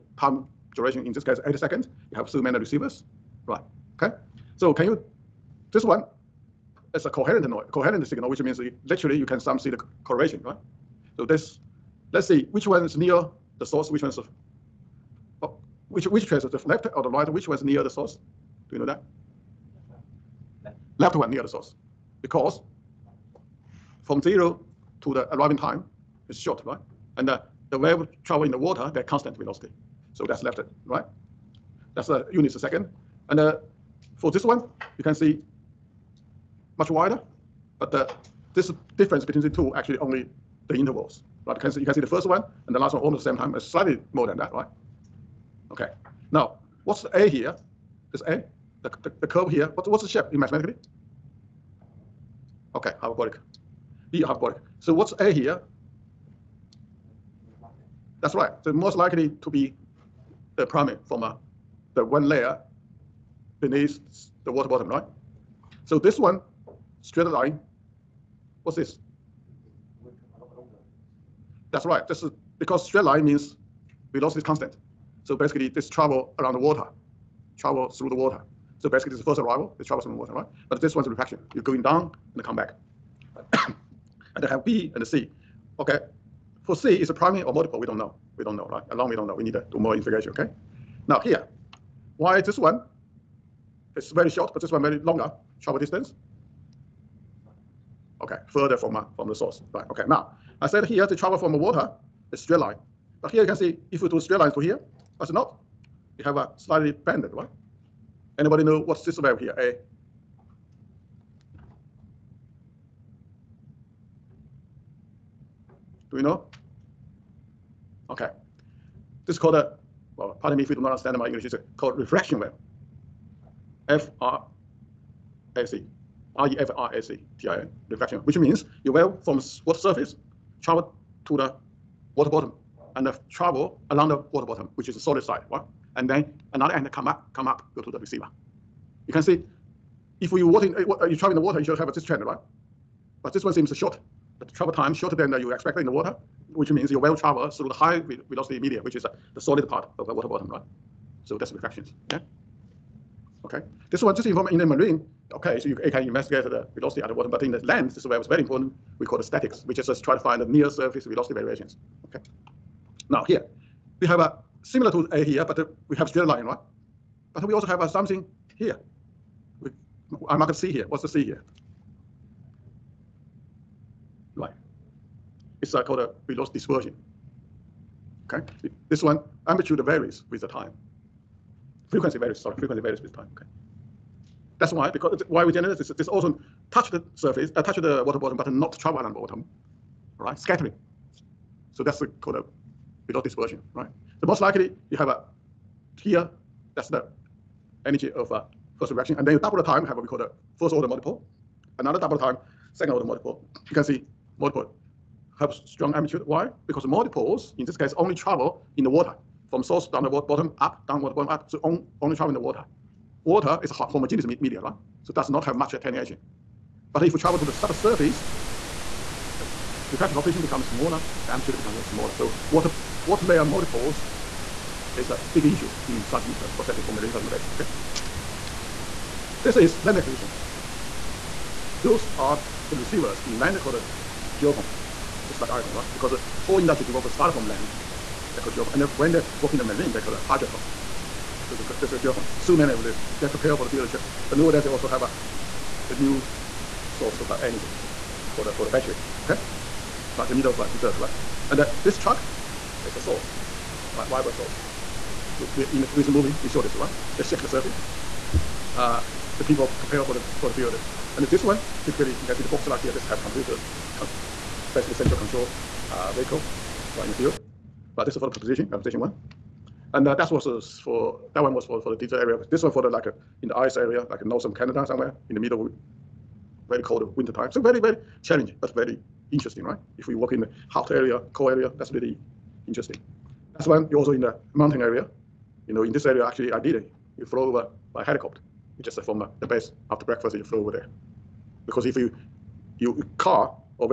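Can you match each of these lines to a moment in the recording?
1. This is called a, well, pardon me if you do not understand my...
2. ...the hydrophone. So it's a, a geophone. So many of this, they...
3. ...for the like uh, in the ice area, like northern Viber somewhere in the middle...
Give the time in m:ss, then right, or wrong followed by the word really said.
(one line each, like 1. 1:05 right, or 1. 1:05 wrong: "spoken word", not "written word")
1. 1:59 right
2. 4:00 right
3. 4:32 wrong: "Canada", not "Viber".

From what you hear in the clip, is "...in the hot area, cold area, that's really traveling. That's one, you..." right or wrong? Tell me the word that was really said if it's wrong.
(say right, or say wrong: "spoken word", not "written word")
wrong: "interesting", not "traveling".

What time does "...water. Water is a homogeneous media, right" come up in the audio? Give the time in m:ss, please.
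3:32.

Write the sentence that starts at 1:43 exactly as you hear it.
But here you can see if we do straight lines to here, that's not.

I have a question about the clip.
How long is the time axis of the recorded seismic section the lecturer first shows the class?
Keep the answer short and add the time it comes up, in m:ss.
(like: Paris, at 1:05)
8 seconds, at 0:01.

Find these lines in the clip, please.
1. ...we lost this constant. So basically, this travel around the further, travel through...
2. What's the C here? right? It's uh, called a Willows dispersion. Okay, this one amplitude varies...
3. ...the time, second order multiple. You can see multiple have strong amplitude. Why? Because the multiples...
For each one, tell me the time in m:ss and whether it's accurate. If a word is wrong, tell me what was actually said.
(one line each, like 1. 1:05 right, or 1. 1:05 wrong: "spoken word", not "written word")
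1. 1:14 wrong: "water", not "further"
2. 2:50 right
3. 3:22 right.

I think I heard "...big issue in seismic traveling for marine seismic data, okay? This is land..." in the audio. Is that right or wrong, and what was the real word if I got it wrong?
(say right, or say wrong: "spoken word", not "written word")
wrong: "processing", not "traveling".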